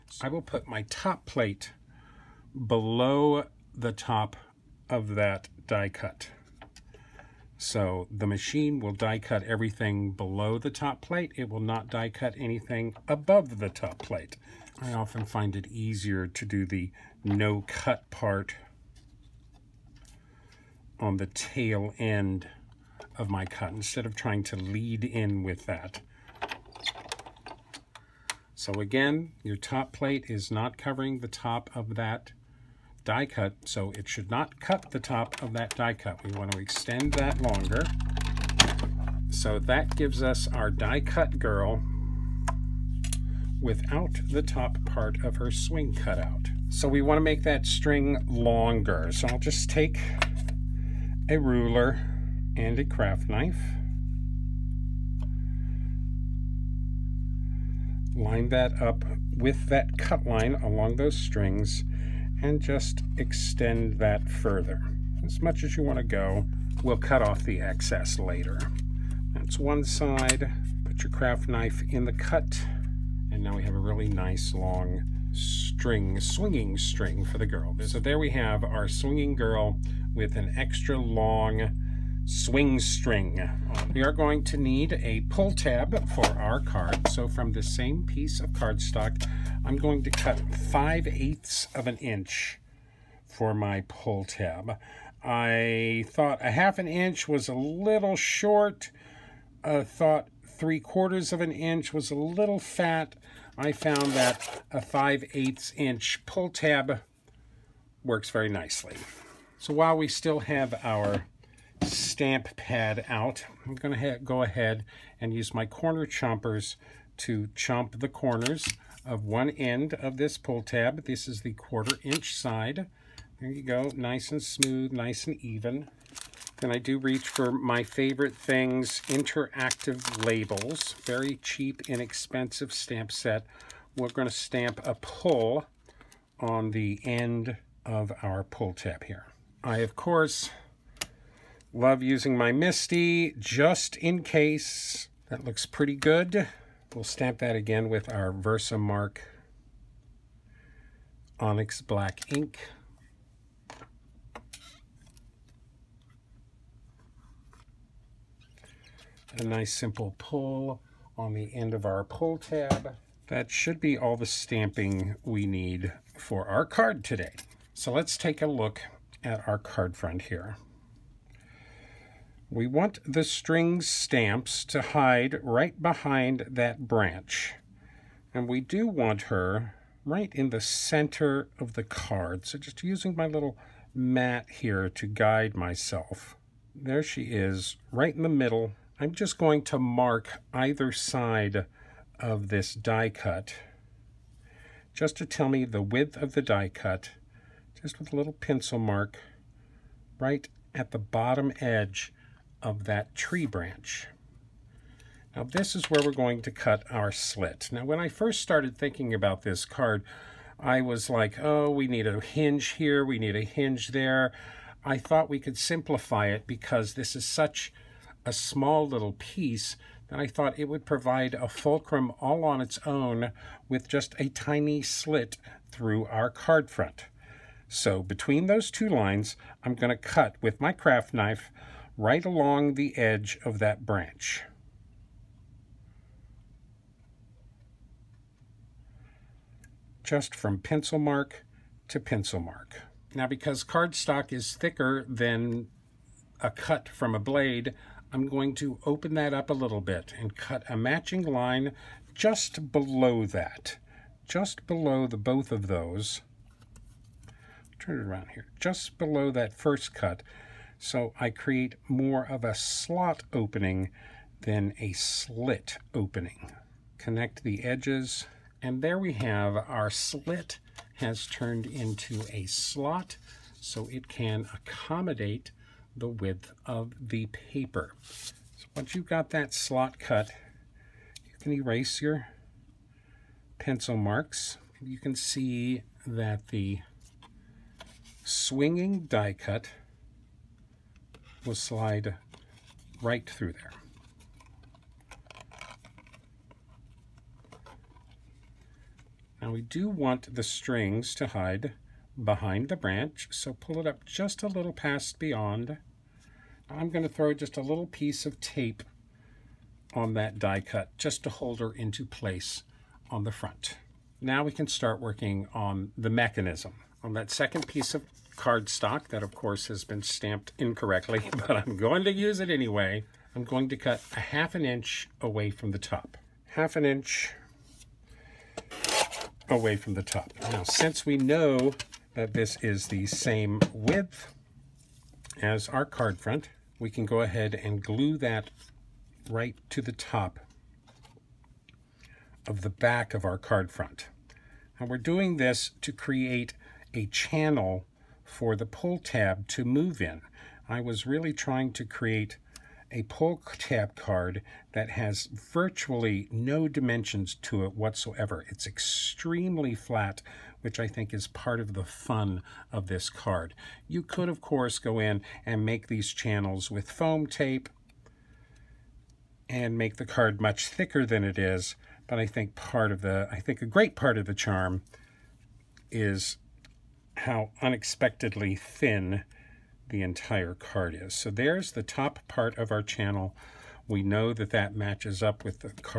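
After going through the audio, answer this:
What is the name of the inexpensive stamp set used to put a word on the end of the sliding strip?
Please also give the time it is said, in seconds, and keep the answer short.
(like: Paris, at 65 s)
interactive labels, at 129 s.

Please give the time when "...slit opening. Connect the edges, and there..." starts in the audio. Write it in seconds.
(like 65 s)
264 s.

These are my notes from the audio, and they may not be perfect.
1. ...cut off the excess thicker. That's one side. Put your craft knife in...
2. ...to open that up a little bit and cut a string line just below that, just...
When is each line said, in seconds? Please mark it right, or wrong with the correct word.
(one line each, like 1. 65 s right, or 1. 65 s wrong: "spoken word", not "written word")
1. 66 s wrong: "later", not "thicker"
2. 248 s wrong: "matching", not "string".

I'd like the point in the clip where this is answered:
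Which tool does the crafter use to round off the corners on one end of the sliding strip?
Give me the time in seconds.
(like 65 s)
115 s.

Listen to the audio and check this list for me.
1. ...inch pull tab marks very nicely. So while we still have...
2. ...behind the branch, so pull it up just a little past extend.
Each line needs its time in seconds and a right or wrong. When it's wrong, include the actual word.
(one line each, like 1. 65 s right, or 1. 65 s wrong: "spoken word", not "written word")
1. 105 s wrong: "works", not "marks"
2. 302 s wrong: "beyond", not "extend".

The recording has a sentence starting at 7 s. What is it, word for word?
So the machine will die cut everything below the top plate.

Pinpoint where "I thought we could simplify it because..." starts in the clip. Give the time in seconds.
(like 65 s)
214 s.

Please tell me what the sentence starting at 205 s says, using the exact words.
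Now this is where we're going to cut our slit.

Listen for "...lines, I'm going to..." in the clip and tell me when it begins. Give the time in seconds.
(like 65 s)
228 s.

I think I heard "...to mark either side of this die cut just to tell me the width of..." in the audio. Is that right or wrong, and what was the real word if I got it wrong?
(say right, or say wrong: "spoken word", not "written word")
right.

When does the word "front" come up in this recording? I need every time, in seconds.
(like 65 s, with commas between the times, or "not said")
169 s, 226 s, 313 s, 336 s, 343 s.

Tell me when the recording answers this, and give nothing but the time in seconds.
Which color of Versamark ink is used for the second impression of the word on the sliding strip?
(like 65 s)
151 s.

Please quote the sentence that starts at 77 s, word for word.
So there we have our swinging girl with an extra long swing string.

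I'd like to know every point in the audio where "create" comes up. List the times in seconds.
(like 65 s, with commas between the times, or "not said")
261 s, 345 s, 351 s.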